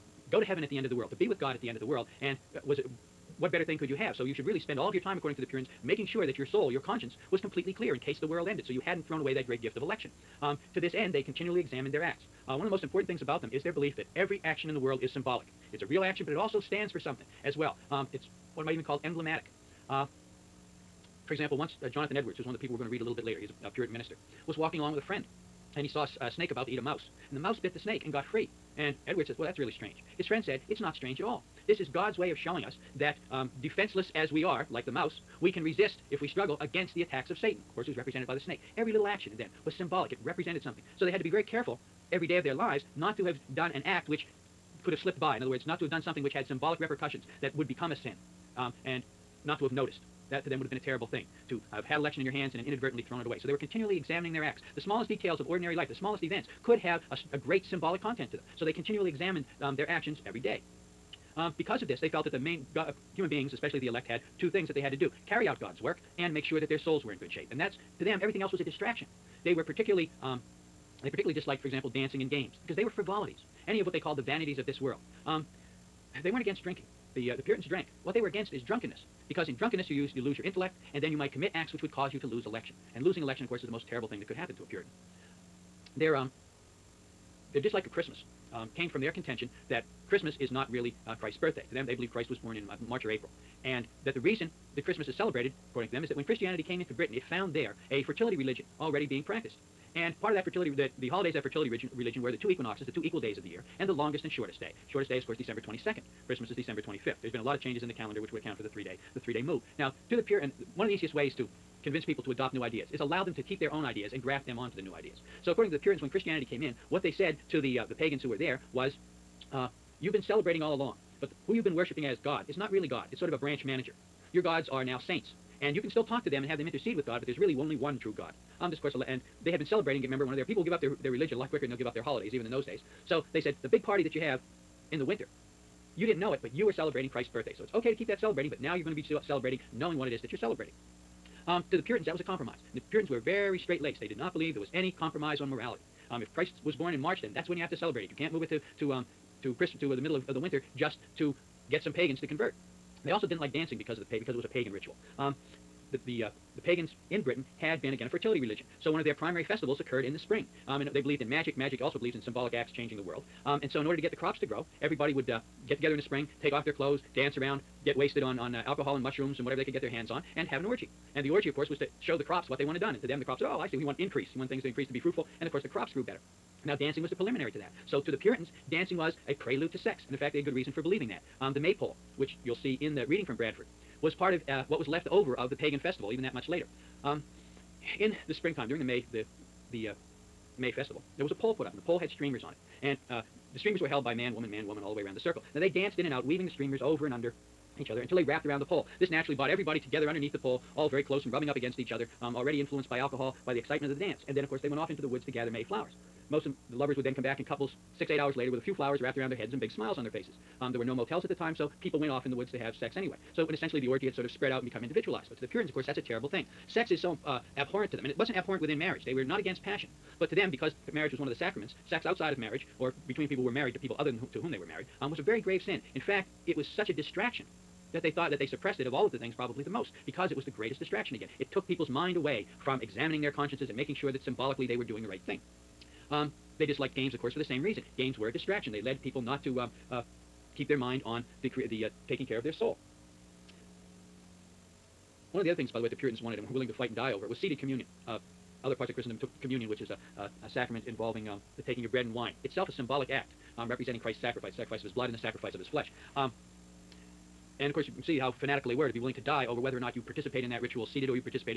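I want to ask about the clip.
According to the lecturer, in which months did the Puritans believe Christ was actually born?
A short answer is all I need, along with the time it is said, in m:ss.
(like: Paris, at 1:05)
March or April, at 1:32.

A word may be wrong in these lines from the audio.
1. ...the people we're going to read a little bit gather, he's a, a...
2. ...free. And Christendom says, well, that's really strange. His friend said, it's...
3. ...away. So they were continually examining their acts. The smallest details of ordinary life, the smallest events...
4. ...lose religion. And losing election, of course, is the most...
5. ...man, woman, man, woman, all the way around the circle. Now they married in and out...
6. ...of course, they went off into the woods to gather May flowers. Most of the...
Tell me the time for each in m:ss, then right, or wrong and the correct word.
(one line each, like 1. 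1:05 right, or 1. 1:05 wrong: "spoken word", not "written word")
1. 0:22 wrong: "later", not "gather"
2. 0:28 wrong: "Edwards", not "Christendom"
3. 0:53 right
4. 1:22 wrong: "election", not "religion"
5. 3:14 wrong: "danced", not "married"
6. 3:24 right.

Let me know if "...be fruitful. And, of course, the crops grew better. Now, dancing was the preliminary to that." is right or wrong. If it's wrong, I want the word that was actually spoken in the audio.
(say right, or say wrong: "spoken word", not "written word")
right.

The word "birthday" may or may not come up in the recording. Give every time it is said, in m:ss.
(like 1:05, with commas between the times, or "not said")
1:31, 2:17.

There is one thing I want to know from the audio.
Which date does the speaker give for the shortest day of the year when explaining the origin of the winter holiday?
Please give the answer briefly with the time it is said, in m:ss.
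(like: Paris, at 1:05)
December 22nd, at 1:45.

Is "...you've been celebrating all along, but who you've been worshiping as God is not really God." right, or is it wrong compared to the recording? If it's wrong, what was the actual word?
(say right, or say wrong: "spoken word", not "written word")
right.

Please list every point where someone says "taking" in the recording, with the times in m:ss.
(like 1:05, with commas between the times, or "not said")
4:02, 4:11.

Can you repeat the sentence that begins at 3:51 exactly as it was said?
It took people's mind away from examining their consciences and making sure that symbolically they were doing the right thing.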